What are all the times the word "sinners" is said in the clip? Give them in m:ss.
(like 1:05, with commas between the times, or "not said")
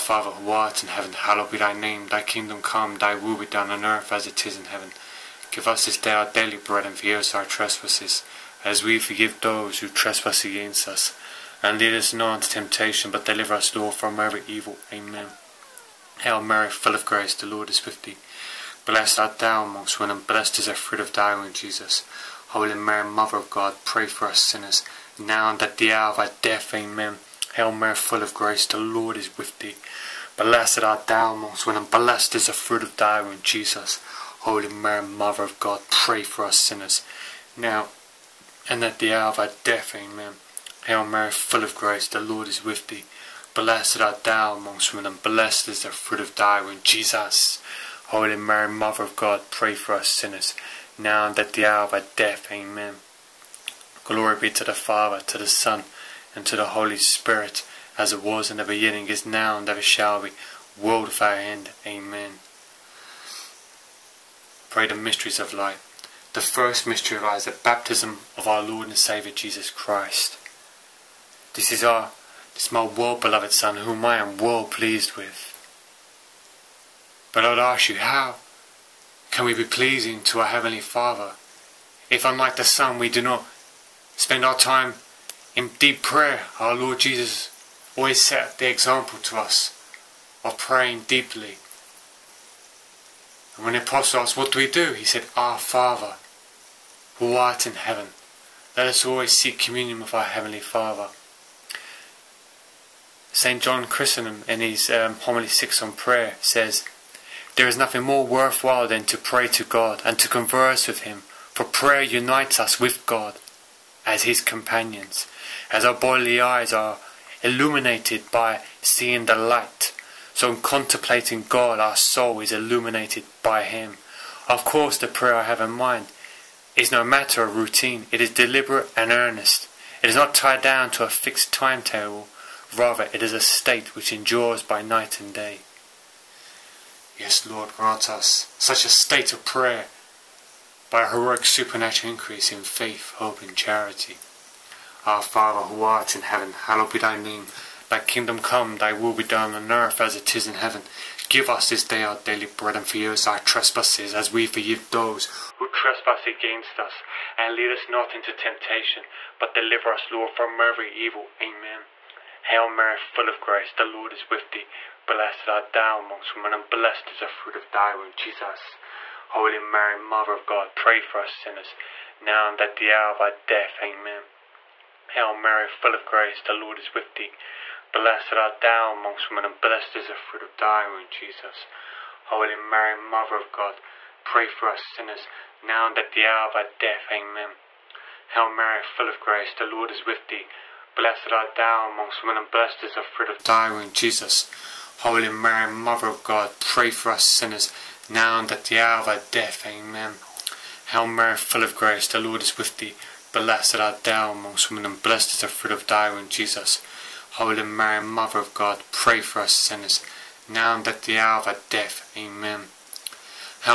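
0:24, 0:36, 0:50, 2:51, 3:04, 3:17, 3:29.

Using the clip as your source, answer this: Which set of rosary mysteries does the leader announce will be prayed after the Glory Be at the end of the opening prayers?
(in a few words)
Mysteries of light.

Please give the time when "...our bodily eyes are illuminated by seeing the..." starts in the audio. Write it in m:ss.
1:55.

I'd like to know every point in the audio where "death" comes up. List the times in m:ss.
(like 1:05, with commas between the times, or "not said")
0:26, 0:39, 0:52, 2:53, 3:06, 3:19, 3:31.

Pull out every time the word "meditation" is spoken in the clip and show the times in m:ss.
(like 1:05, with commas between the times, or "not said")
not said.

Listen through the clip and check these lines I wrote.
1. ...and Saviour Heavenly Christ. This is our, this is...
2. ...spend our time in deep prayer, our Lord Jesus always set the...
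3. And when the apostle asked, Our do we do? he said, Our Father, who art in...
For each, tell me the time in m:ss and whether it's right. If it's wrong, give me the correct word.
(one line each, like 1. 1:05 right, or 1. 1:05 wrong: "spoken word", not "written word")
1. 1:08 wrong: "Jesus", not "Heavenly"
2. 1:24 right
3. 1:33 wrong: "What", not "Our".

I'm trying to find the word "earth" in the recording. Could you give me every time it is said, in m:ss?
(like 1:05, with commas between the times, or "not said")
0:03, 2:29.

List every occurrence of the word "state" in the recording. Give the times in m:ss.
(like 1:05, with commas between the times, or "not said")
2:13, 2:18.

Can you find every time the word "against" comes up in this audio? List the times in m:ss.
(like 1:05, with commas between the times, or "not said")
0:10, 2:36.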